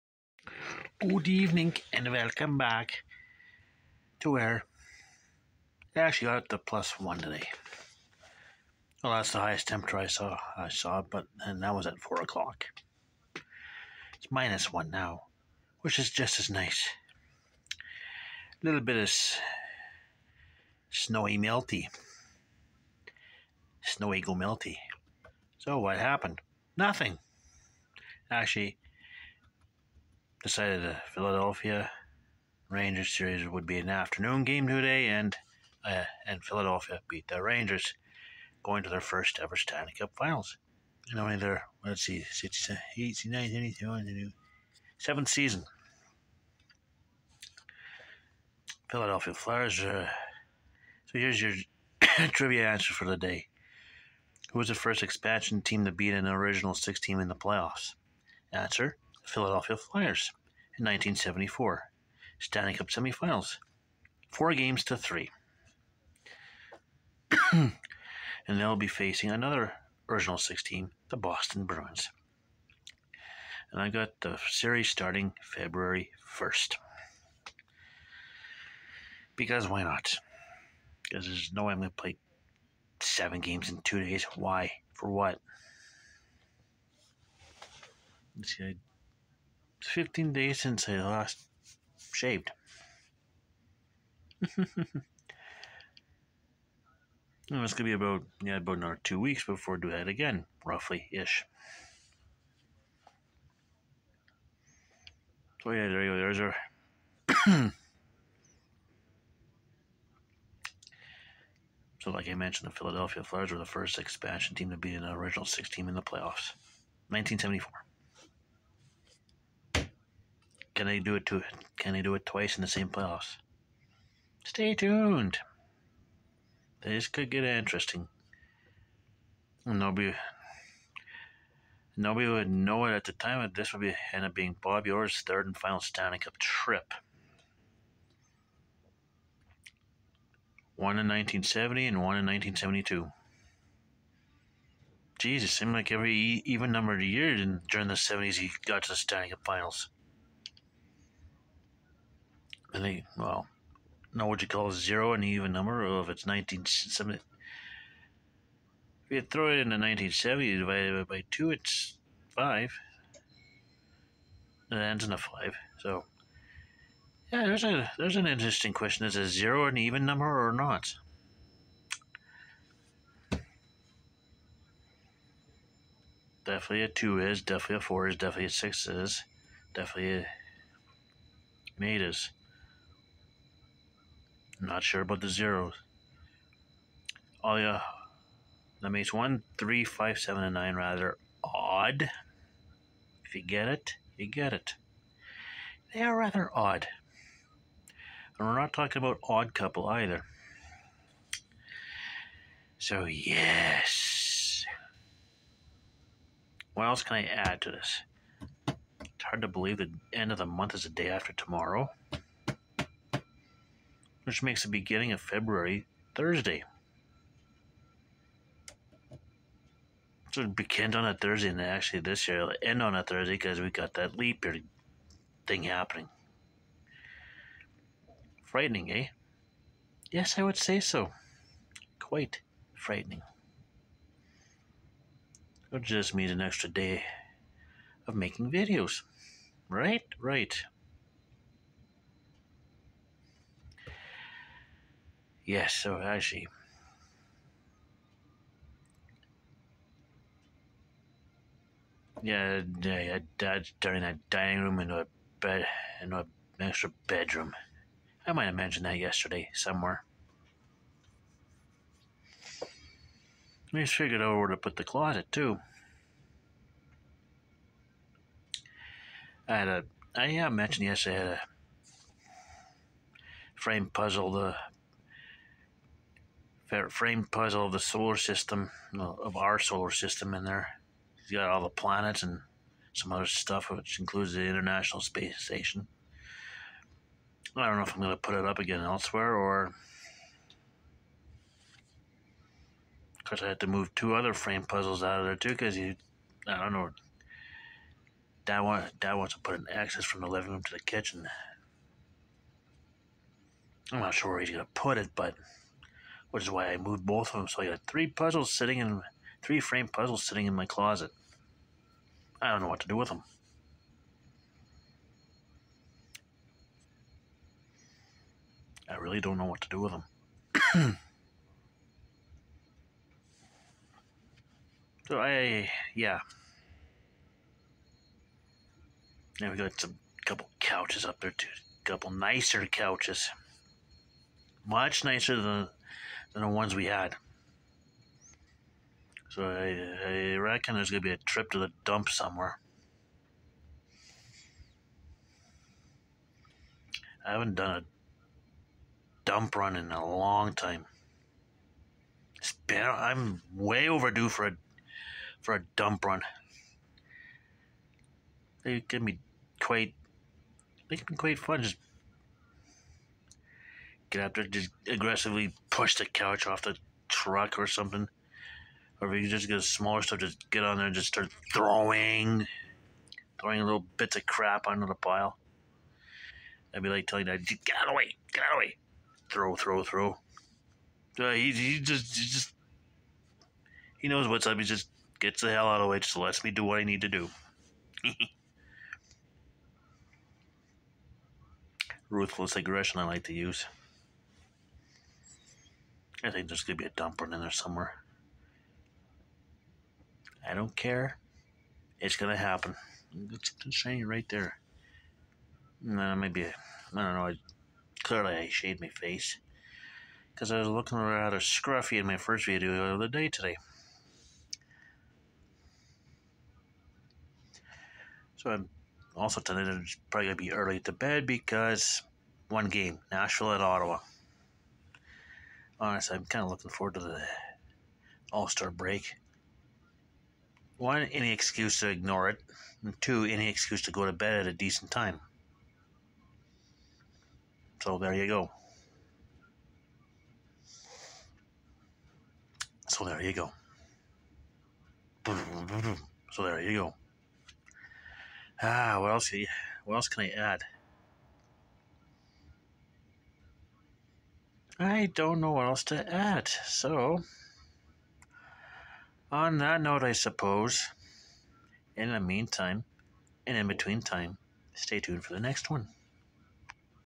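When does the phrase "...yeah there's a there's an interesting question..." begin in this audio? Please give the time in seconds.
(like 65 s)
167 s.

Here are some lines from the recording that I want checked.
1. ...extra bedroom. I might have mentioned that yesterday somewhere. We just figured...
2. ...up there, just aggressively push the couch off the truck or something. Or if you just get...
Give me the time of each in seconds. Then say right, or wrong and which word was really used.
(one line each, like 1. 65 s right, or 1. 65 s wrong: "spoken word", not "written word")
1. 256 s right
2. 364 s right.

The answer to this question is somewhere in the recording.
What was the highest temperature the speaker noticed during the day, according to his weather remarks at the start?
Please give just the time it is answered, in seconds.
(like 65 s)
6 s.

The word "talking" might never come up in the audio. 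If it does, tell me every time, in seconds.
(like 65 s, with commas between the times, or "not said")
198 s.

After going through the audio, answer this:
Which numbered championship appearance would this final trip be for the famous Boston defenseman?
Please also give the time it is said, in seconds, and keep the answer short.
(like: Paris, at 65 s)
third, at 135 s.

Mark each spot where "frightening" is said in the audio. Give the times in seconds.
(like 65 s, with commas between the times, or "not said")
228 s, 232 s.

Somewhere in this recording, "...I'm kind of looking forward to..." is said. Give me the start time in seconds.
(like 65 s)
426 s.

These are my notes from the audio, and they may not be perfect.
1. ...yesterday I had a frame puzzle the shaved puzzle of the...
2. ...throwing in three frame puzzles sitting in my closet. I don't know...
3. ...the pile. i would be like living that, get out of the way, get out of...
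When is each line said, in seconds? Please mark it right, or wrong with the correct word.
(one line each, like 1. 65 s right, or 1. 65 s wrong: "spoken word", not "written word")
1. 270 s wrong: "framed", not "shaved"
2. 308 s wrong: "sitting", not "throwing"
3. 374 s wrong: "telling", not "living".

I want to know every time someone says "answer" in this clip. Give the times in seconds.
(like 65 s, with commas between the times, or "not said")
52 s, 58 s.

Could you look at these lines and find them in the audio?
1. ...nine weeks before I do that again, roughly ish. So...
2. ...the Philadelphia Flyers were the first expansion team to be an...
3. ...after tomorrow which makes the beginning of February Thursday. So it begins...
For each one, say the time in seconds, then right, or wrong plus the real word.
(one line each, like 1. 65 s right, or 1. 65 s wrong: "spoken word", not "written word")
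1. 99 s wrong: "two", not "nine"
2. 112 s right
3. 211 s right.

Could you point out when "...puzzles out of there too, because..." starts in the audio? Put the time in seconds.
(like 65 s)
294 s.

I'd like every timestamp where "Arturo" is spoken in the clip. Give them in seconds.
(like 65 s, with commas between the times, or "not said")
not said.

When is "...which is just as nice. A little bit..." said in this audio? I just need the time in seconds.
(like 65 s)
15 s.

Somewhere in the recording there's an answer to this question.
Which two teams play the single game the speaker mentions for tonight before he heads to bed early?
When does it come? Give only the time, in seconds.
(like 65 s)
423 s.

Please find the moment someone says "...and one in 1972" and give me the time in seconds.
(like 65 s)
141 s.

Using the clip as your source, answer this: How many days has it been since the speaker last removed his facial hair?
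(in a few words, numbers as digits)
15.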